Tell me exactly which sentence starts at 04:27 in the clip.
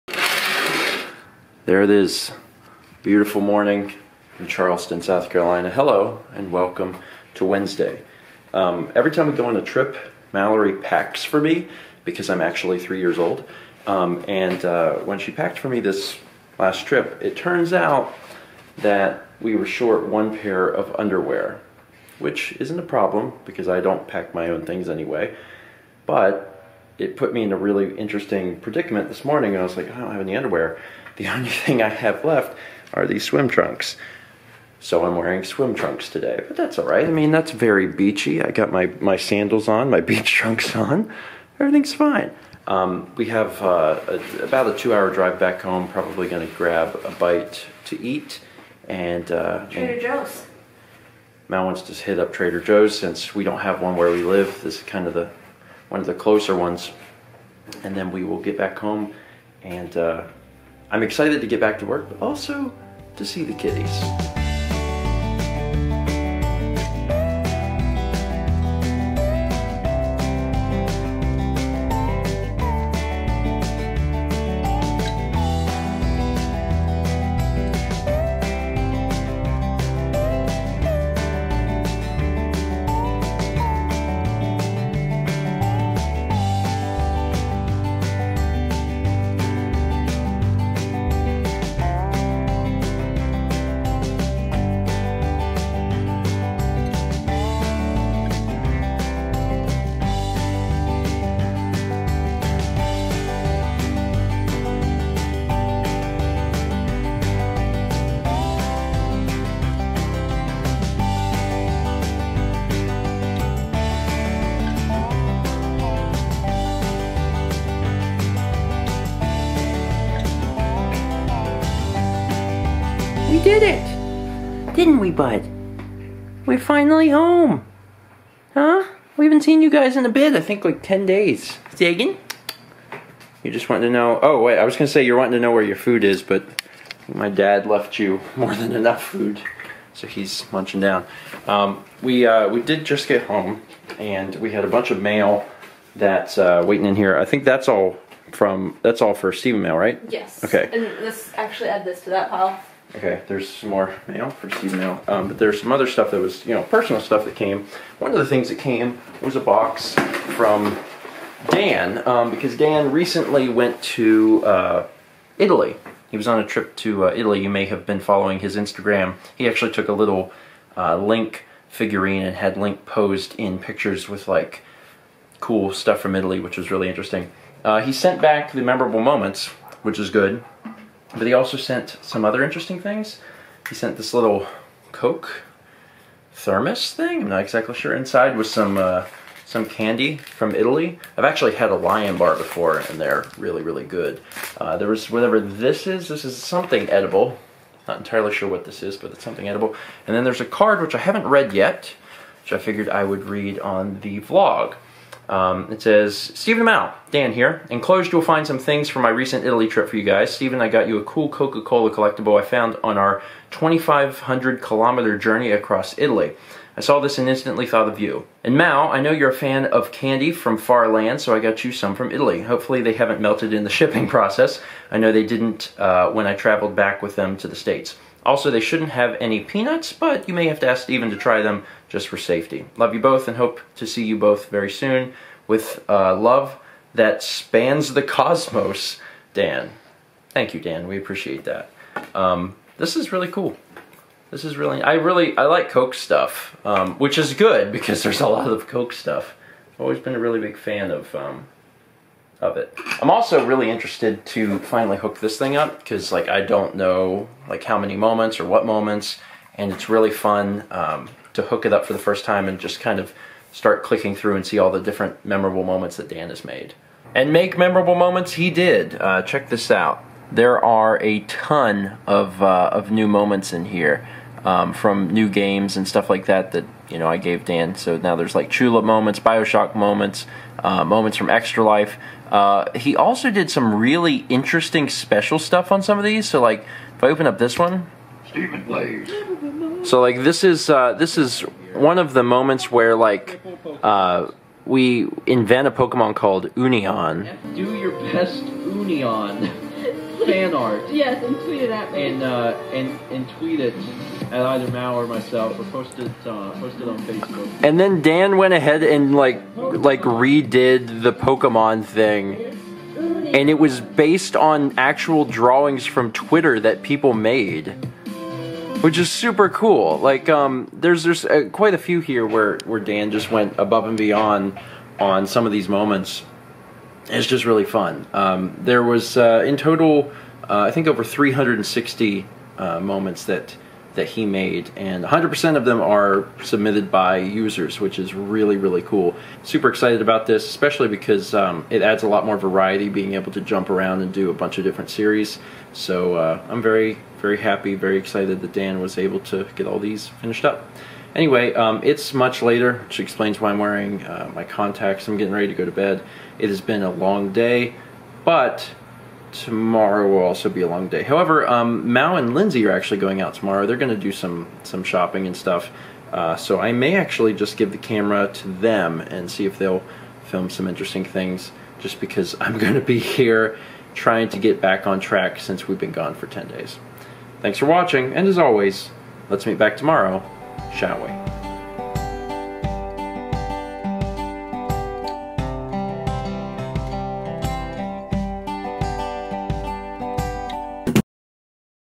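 And make memorable moments he did.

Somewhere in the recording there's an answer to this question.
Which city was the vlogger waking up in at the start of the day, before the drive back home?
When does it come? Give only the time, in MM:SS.
00:04.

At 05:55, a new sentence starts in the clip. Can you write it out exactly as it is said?
I'm getting ready to go to bed.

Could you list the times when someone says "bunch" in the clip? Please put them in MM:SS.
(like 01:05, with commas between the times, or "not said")
02:24, 05:44.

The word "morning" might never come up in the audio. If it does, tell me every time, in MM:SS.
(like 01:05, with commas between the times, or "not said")
00:03, 00:29.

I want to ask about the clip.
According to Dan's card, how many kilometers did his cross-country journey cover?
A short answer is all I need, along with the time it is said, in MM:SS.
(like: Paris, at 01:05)
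2,500, at 03:33.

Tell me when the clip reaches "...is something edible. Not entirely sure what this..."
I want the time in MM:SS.
03:16.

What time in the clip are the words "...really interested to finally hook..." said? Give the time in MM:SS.
04:13.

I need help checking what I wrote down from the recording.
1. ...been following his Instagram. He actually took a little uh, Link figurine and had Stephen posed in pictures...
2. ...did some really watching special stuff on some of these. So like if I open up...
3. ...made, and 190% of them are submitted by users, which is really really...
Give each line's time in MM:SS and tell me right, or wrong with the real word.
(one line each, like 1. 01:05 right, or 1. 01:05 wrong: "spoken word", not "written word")
1. 02:47 wrong: "Link", not "Stephen"
2. 04:43 wrong: "interesting", not "watching"
3. 05:34 wrong: "100", not "190".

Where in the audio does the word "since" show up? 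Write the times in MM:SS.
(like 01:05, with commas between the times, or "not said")
00:52, 06:15.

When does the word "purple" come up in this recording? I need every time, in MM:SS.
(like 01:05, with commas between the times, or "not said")
not said.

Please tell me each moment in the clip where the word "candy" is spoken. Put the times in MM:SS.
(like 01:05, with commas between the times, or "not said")
03:09, 03:39.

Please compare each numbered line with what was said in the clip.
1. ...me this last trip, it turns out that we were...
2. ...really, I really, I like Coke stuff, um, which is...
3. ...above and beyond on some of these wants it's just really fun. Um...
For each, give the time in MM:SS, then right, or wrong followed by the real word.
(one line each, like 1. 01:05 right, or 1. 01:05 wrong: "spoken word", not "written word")
1. 00:15 right
2. 04:04 right
3. 05:23 wrong: "moments", not "wants".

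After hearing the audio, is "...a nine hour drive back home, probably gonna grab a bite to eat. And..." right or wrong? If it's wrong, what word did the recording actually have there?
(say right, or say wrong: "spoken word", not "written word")
wrong: "two", not "nine".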